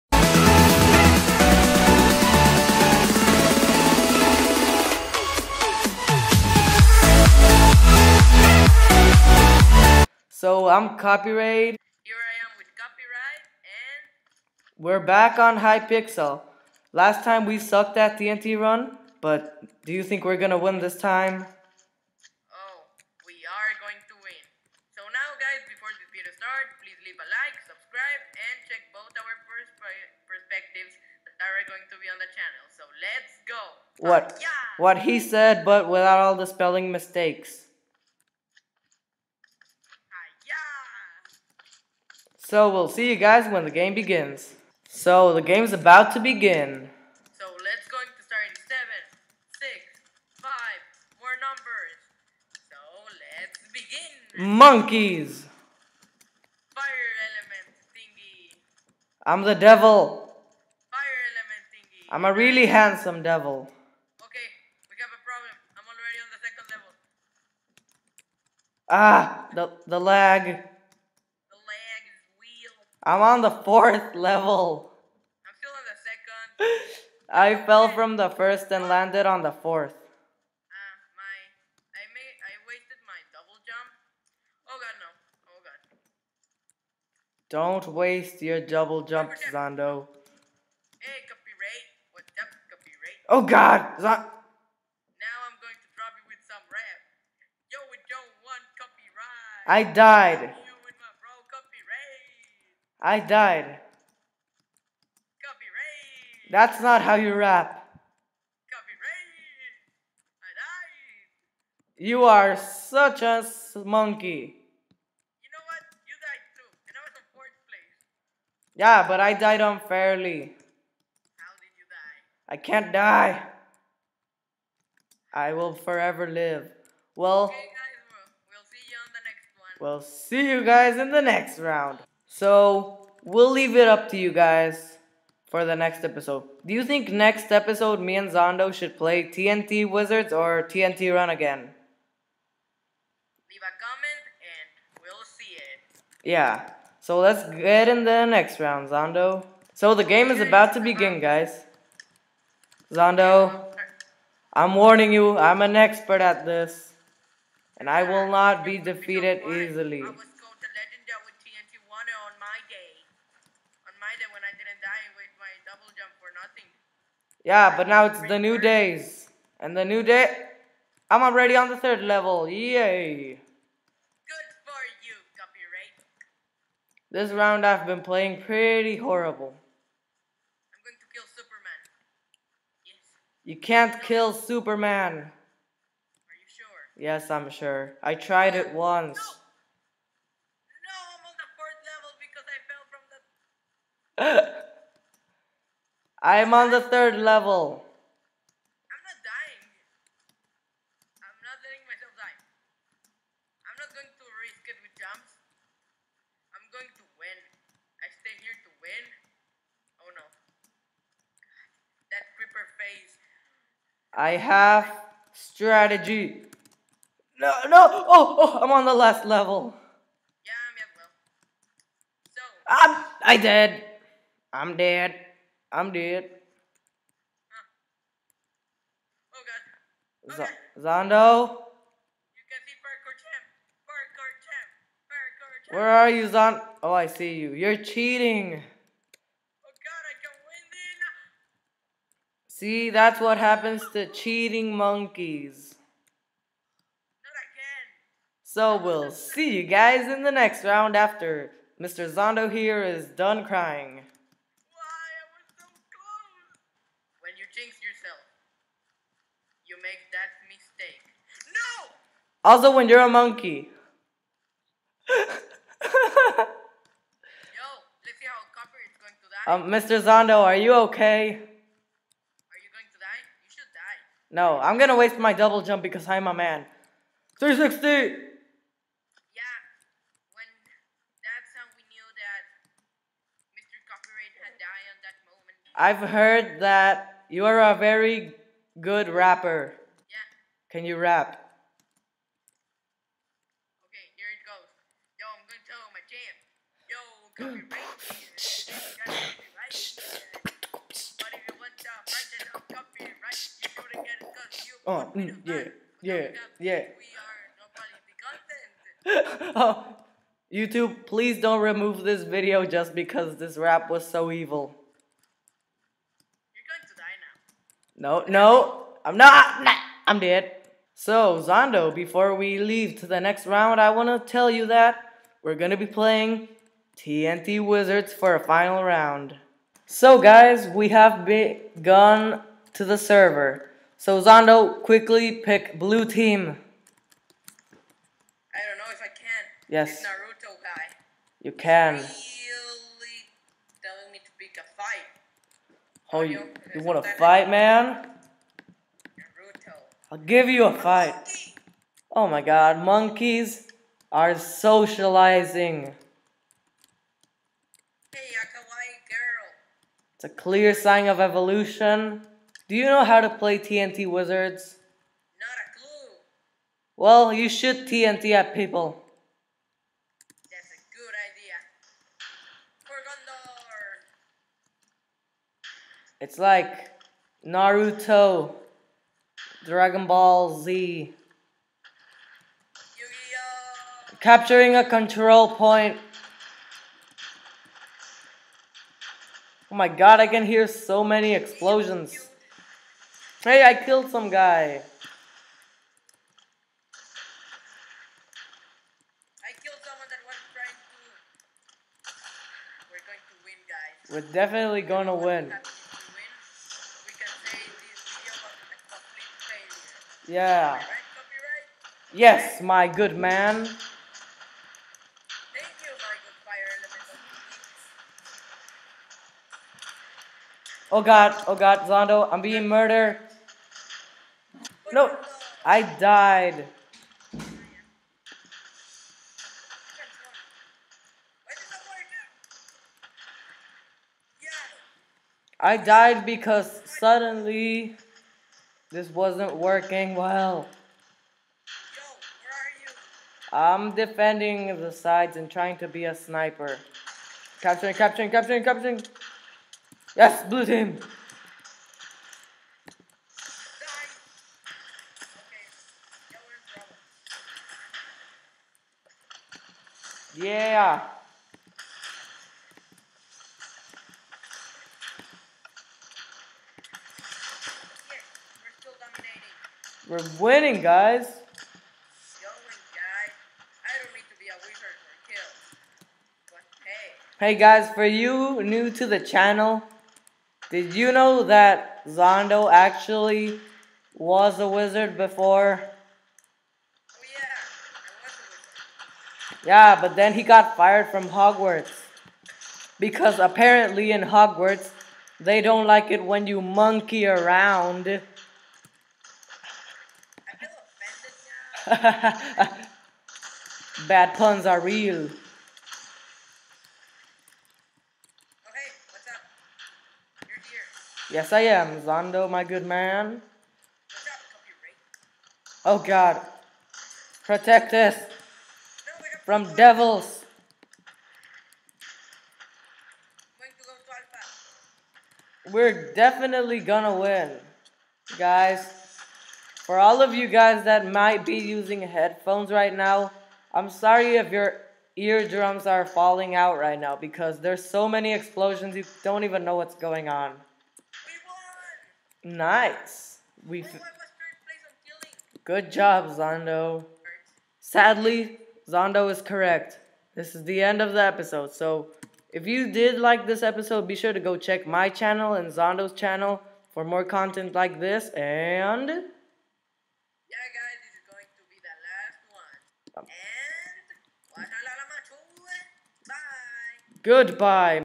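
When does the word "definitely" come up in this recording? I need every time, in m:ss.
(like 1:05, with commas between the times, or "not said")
6:44, 8:46.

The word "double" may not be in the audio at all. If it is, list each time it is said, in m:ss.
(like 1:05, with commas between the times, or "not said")
1:23, 1:28, 4:35.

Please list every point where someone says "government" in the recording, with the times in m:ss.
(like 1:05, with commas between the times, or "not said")
not said.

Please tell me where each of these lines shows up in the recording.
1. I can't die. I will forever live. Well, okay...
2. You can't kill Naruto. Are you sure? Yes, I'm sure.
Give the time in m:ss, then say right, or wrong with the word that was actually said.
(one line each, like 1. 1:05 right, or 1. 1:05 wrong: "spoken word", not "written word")
1. 2:02 right
2. 3:03 wrong: "Superman", not "Naruto".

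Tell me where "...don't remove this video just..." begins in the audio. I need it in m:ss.
5:11.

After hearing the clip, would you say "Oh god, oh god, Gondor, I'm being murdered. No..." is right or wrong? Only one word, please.
wrong.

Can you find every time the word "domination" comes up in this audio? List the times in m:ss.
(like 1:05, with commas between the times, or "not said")
not said.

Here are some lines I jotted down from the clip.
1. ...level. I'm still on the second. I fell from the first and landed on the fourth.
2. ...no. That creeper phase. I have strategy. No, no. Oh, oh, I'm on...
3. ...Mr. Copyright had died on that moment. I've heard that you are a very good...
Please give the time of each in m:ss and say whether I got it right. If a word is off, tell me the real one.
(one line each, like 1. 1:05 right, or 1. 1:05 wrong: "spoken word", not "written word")
1. 1:14 right
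2. 3:30 right
3. 4:43 right.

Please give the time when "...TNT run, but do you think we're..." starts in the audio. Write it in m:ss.
0:18.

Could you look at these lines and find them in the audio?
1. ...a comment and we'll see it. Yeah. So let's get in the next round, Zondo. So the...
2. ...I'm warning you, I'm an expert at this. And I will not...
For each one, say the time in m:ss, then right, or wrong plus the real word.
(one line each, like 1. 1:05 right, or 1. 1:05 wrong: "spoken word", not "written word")
1. 2:23 right
2. 2:34 right.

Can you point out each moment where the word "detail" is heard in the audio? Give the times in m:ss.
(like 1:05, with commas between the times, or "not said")
not said.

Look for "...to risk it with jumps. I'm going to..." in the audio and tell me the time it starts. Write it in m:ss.
3:24.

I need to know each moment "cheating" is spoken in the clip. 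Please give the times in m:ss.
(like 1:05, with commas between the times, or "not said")
3:57, 4:04.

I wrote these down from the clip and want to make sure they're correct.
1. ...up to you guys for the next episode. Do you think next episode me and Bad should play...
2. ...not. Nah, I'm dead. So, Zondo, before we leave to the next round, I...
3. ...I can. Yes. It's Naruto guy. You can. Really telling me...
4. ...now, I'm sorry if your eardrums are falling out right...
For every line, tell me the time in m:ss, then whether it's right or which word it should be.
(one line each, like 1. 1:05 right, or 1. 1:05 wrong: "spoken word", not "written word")
1. 2:13 wrong: "Zondo", not "Bad"
2. 5:19 right
3. 5:39 right
4. 8:52 right.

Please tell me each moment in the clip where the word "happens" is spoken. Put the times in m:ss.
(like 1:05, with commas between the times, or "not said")
4:03.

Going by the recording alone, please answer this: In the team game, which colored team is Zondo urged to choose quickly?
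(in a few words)
Blue.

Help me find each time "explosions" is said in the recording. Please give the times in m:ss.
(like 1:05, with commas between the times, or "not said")
6:31, 8:58.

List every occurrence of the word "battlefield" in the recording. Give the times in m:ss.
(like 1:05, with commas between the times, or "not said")
not said.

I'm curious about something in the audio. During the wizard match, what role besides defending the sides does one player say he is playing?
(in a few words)
Sniper.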